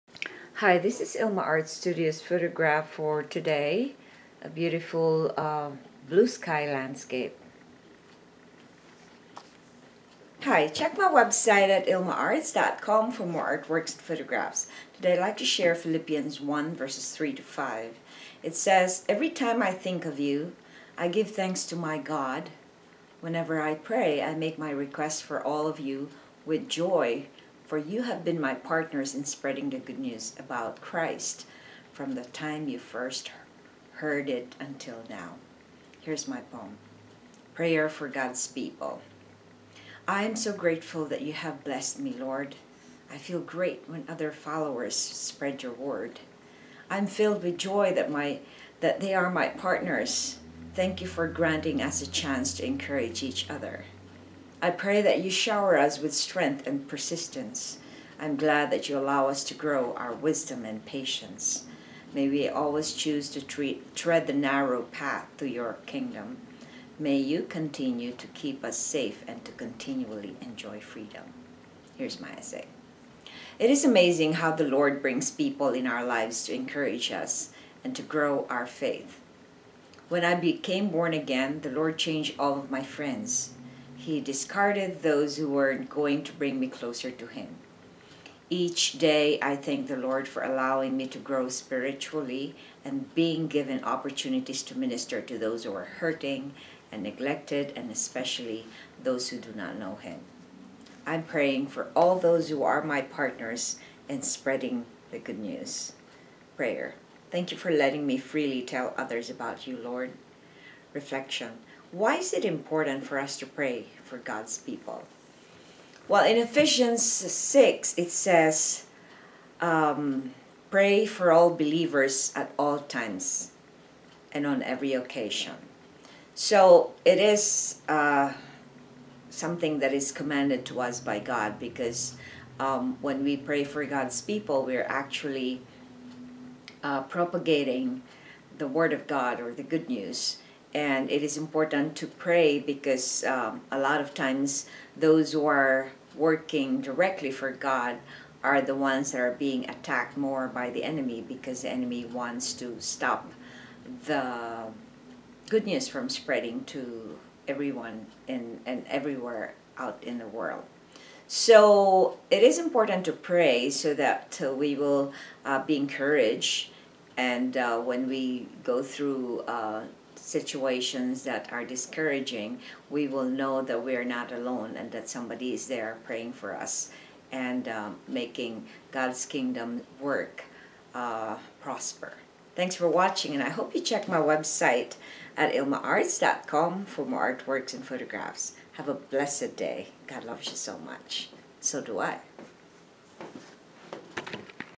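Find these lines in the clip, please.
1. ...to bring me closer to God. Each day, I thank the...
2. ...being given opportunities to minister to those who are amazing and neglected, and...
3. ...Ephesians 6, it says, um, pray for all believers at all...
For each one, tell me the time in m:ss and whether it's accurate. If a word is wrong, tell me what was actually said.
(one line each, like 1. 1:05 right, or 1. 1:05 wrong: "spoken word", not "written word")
1. 1:26 wrong: "Him", not "God"
2. 1:33 wrong: "hurting", not "amazing"
3. 1:56 right.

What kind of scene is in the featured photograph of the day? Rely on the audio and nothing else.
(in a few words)
Blue sky landscape.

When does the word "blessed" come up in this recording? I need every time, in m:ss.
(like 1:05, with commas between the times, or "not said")
0:41, 3:08.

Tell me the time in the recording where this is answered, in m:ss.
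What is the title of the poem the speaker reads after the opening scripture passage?
0:37.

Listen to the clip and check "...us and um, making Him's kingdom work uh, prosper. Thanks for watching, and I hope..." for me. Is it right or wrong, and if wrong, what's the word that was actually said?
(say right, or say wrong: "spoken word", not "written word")
wrong: "God", not "Him".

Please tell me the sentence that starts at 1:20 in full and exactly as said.
When I became born again, the Lord changed all of my friends.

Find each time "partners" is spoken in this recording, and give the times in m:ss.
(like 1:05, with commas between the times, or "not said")
0:28, 0:49, 1:43.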